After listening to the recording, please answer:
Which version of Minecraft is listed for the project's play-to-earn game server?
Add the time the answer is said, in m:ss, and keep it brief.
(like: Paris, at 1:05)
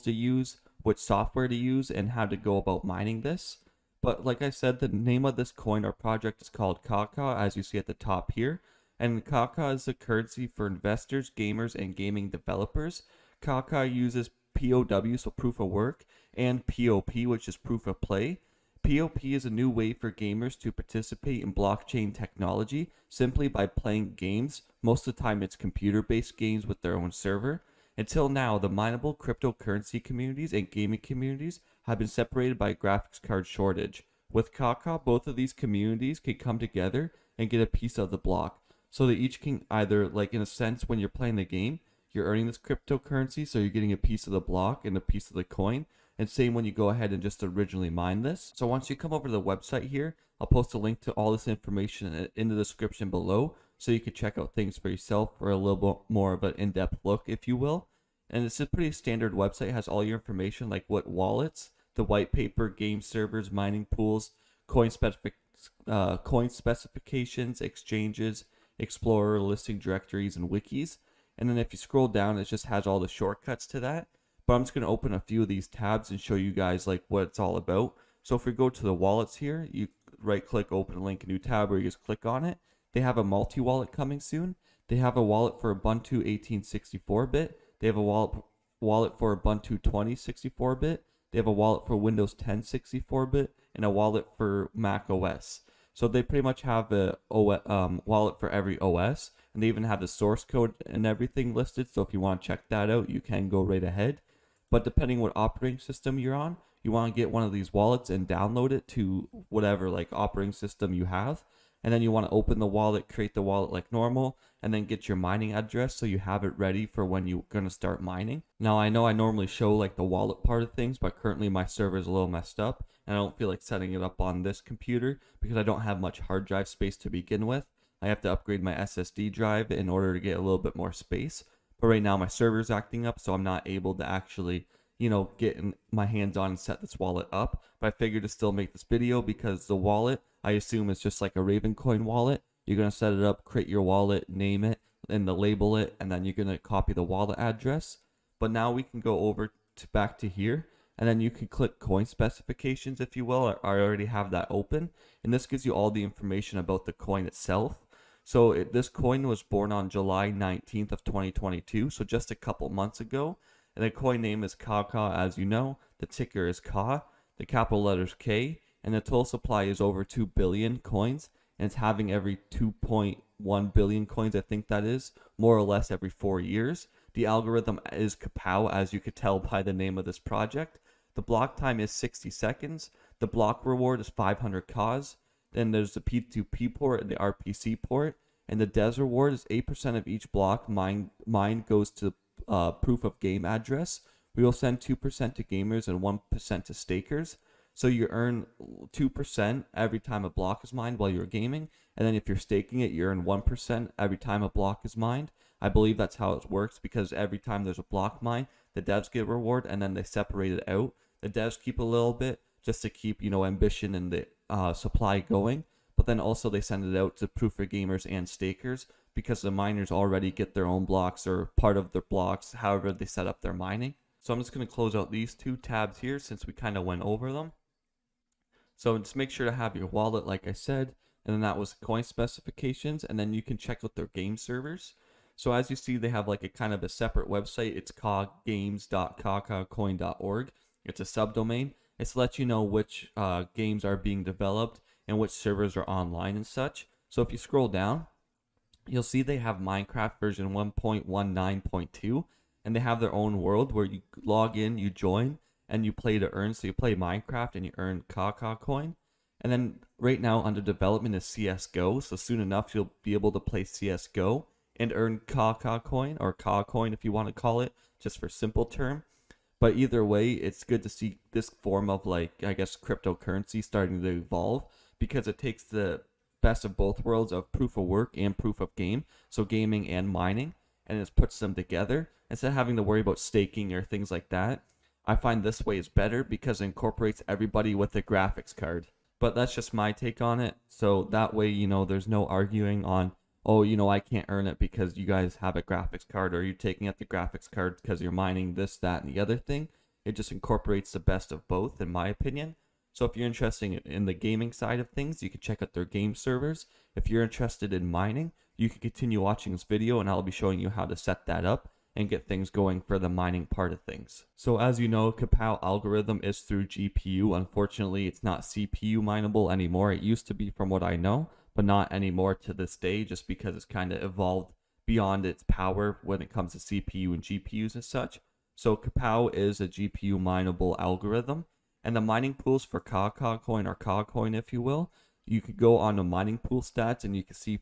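1.19.2, at 4:10.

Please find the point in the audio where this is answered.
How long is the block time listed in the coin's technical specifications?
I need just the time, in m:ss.
3:01.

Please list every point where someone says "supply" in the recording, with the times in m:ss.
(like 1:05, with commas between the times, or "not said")
2:49, 3:34.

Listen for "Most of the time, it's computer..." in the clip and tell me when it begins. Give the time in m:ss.
0:24.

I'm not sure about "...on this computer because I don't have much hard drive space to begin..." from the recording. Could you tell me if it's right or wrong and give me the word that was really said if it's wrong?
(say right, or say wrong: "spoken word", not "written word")
right.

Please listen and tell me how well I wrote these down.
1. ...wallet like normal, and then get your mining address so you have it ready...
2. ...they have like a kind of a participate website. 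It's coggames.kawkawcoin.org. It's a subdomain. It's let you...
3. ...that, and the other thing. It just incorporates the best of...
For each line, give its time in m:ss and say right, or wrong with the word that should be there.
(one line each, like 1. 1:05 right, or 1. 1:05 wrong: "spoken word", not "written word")
1. 1:53 right
2. 3:55 wrong: "separate", not "participate"
3. 4:58 right.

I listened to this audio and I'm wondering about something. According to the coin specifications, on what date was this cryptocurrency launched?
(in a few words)
July 19th, 2022.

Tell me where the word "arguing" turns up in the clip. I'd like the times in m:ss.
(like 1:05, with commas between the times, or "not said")
4:52.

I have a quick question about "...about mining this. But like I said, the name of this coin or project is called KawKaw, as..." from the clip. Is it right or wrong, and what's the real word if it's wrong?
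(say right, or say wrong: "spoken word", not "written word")
right.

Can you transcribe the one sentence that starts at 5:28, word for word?
So KawPow is a GPU mineable algorithm and the mining pools for KawKaw coin or Ka coin, if you will.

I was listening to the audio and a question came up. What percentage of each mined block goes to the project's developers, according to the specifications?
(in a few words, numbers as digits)
8%.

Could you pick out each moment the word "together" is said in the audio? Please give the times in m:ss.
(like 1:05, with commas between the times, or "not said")
0:36, 4:41.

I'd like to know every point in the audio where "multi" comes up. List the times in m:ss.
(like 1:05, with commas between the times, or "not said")
1:23.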